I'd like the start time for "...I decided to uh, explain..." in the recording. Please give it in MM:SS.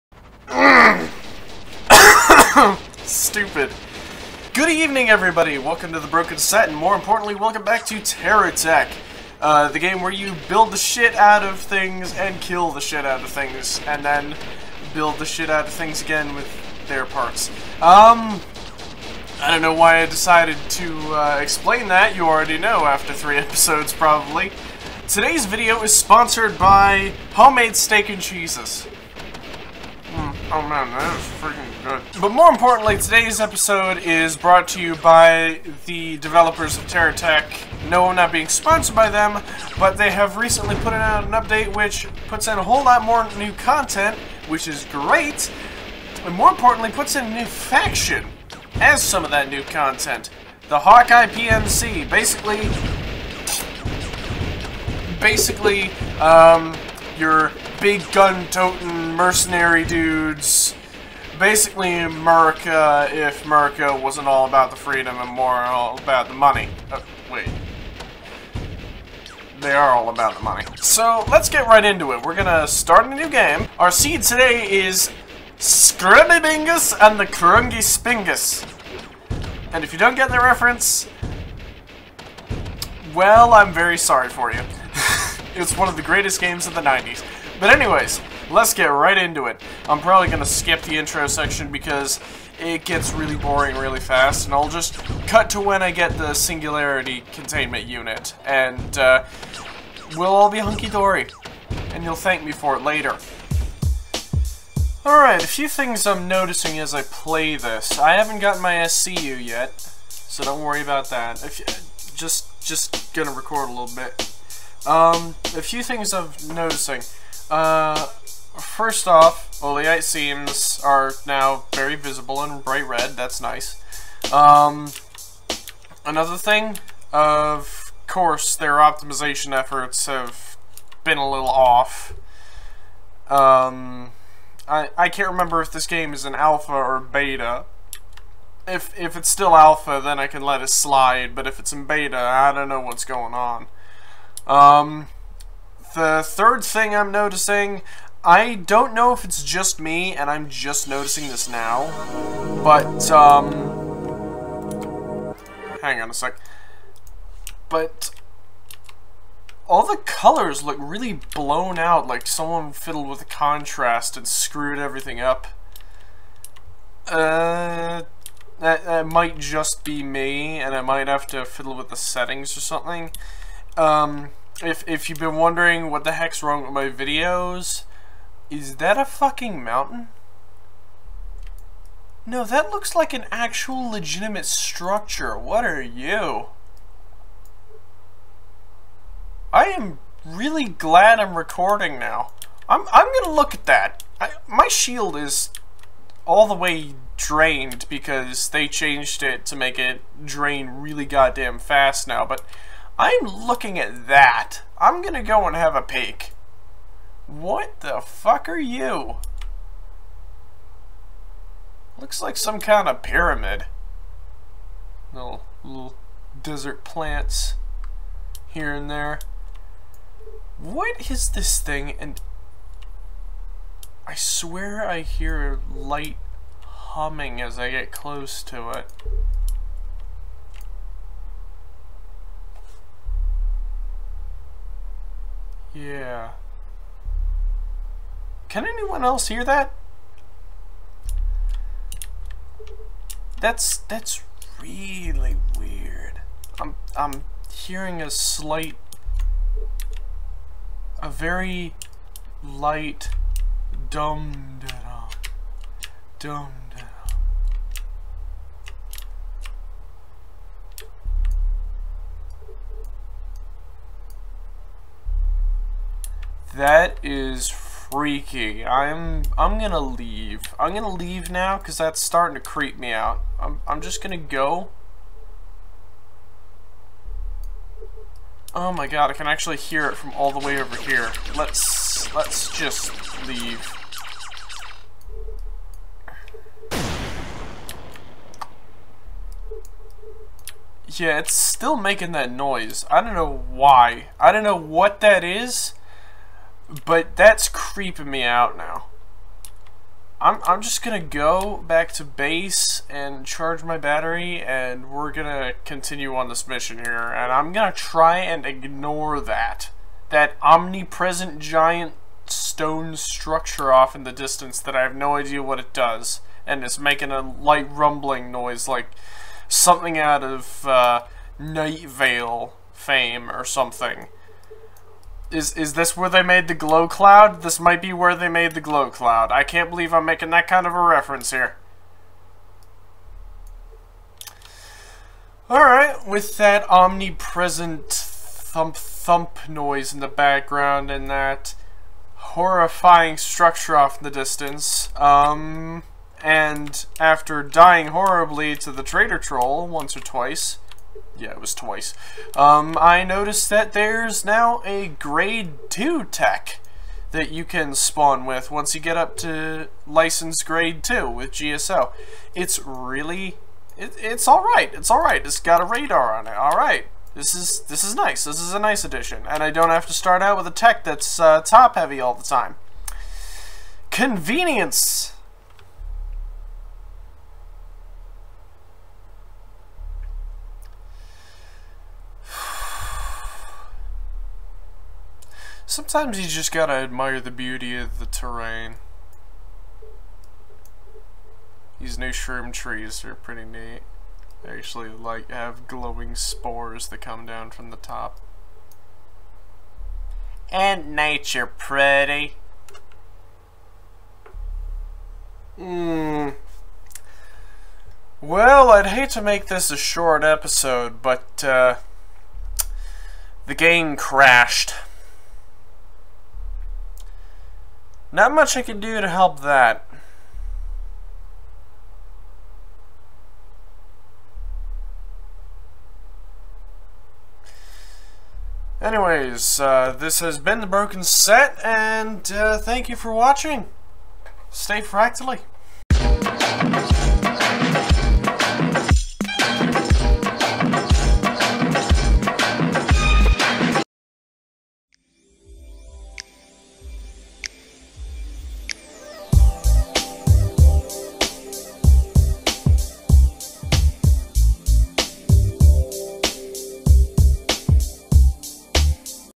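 00:20.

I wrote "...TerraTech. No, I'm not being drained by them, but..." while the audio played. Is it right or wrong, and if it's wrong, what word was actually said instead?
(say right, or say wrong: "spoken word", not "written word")
wrong: "sponsored", not "drained".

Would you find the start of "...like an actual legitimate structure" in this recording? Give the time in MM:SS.
03:02.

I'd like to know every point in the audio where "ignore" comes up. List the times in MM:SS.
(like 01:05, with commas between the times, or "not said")
05:08.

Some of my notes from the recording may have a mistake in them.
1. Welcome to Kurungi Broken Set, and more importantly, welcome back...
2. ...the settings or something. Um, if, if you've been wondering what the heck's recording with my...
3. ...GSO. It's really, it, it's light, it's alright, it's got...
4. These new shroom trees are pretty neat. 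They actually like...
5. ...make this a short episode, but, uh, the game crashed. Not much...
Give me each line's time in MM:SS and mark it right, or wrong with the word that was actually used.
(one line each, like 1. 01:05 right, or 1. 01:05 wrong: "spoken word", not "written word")
1. 00:05 wrong: "The", not "Kurungi"
2. 02:51 wrong: "wrong", not "recording"
3. 06:01 wrong: "alright", not "light"
4. 06:31 right
5. 06:49 right.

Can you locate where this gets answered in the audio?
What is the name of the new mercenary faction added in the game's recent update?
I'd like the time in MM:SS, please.
00:50.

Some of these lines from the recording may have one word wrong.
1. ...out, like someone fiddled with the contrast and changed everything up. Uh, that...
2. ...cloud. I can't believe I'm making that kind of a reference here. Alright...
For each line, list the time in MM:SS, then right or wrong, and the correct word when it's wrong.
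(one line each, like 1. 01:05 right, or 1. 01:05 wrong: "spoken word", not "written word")
1. 02:41 wrong: "screwed", not "changed"
2. 05:28 right.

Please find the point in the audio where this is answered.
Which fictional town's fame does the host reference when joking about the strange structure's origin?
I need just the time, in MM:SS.
05:21.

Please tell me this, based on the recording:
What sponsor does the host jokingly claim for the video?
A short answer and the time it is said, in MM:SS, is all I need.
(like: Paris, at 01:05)
Homemade Steak and Cheeses, at 00:27.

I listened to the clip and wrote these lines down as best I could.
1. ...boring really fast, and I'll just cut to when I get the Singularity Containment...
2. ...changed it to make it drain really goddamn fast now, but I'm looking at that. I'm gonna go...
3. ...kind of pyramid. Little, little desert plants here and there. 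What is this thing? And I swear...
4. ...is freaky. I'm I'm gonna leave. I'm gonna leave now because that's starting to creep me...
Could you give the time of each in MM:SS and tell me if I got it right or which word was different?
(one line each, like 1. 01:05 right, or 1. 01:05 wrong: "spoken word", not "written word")
1. 01:33 right
2. 03:18 right
3. 03:32 right
4. 04:27 right.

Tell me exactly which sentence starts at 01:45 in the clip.
Alright, a few things I'm noticing as I play this.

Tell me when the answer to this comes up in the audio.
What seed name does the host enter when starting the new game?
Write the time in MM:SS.
01:15.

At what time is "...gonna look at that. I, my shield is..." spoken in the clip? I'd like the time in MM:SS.
03:13.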